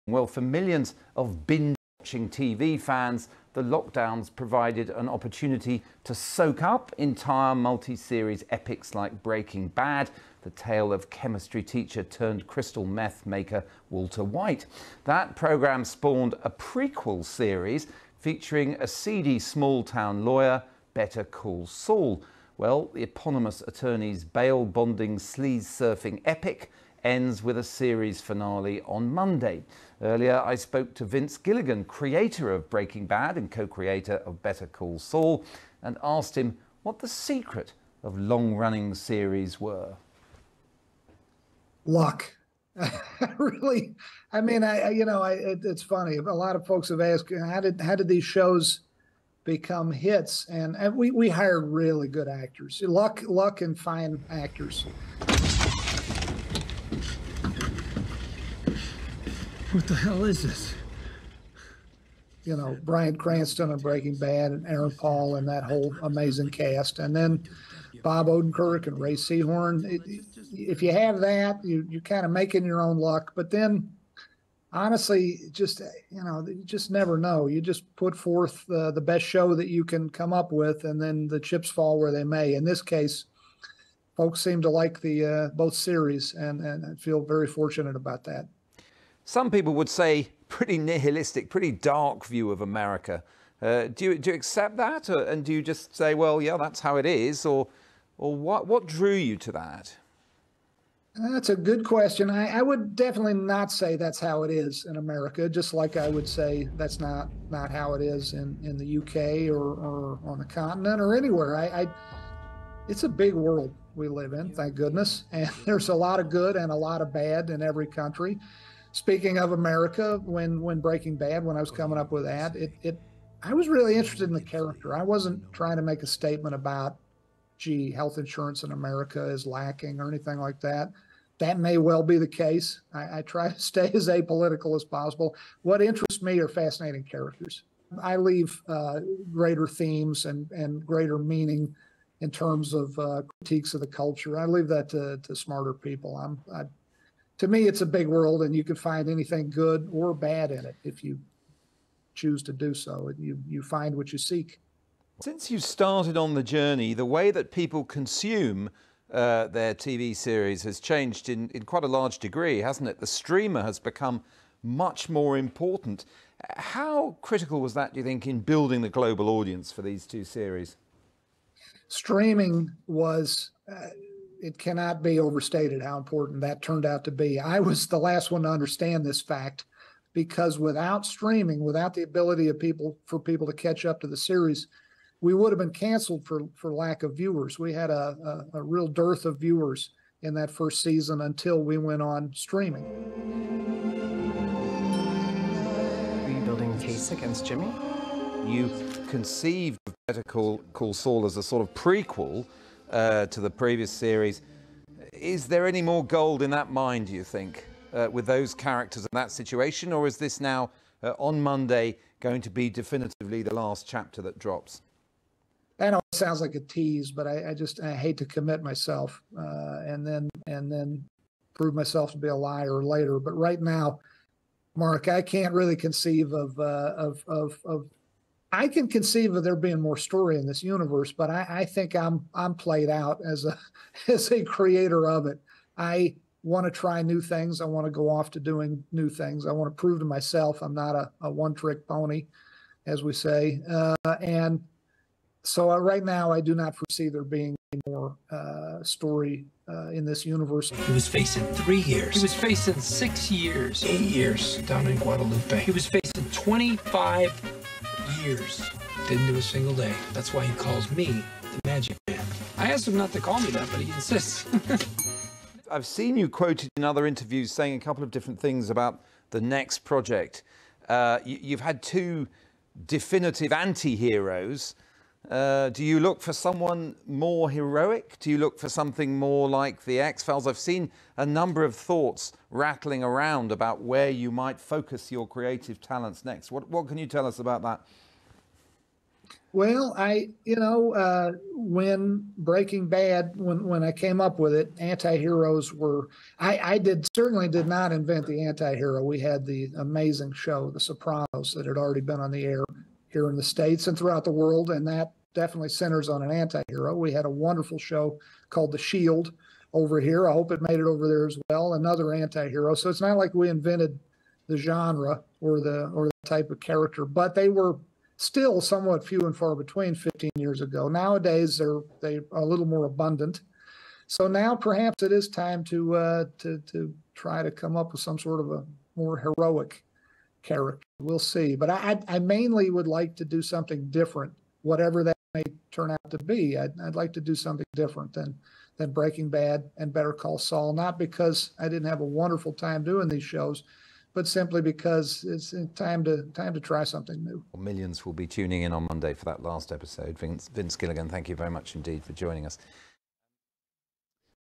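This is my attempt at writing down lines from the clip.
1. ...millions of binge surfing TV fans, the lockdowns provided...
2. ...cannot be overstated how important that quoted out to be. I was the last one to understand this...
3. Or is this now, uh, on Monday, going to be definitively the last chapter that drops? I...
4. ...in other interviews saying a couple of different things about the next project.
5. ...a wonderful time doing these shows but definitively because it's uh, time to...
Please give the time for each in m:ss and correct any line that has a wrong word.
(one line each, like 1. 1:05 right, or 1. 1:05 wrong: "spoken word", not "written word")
1. 0:00 wrong: "watching", not "surfing"
2. 2:54 wrong: "turned", not "quoted"
3. 3:29 right
4. 4:26 right
5. 5:42 wrong: "simply", not "definitively".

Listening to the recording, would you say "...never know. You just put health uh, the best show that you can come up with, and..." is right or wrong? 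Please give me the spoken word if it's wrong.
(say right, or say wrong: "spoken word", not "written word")
wrong: "forth", not "health".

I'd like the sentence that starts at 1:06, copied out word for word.
And then Bob Odenkirk and Rhea Seehorn.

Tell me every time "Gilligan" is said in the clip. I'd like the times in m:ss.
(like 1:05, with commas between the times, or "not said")
0:31, 5:50.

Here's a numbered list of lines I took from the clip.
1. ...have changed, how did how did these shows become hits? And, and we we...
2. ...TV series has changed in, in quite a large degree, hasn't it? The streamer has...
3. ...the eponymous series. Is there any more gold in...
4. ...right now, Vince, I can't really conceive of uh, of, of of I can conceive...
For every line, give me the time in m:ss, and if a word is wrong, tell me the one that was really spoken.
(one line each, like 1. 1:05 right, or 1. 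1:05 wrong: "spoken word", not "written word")
1. 0:46 wrong: "asked", not "changed"
2. 2:39 right
3. 3:23 wrong: "previous", not "eponymous"
4. 3:43 wrong: "Mark", not "Vince".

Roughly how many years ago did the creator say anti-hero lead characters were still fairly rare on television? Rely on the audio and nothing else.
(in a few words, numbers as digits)
15.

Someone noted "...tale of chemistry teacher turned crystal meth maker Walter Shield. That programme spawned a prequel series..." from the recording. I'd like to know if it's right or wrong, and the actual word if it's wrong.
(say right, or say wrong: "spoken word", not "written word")
wrong: "White", not "Shield".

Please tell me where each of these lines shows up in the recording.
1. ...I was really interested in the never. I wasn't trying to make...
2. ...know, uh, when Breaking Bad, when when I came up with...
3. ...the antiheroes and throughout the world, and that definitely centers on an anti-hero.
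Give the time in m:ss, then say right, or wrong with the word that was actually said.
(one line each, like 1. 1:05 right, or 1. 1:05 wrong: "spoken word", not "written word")
1. 2:03 wrong: "character", not "never"
2. 4:50 right
3. 5:03 wrong: "states", not "antiheroes".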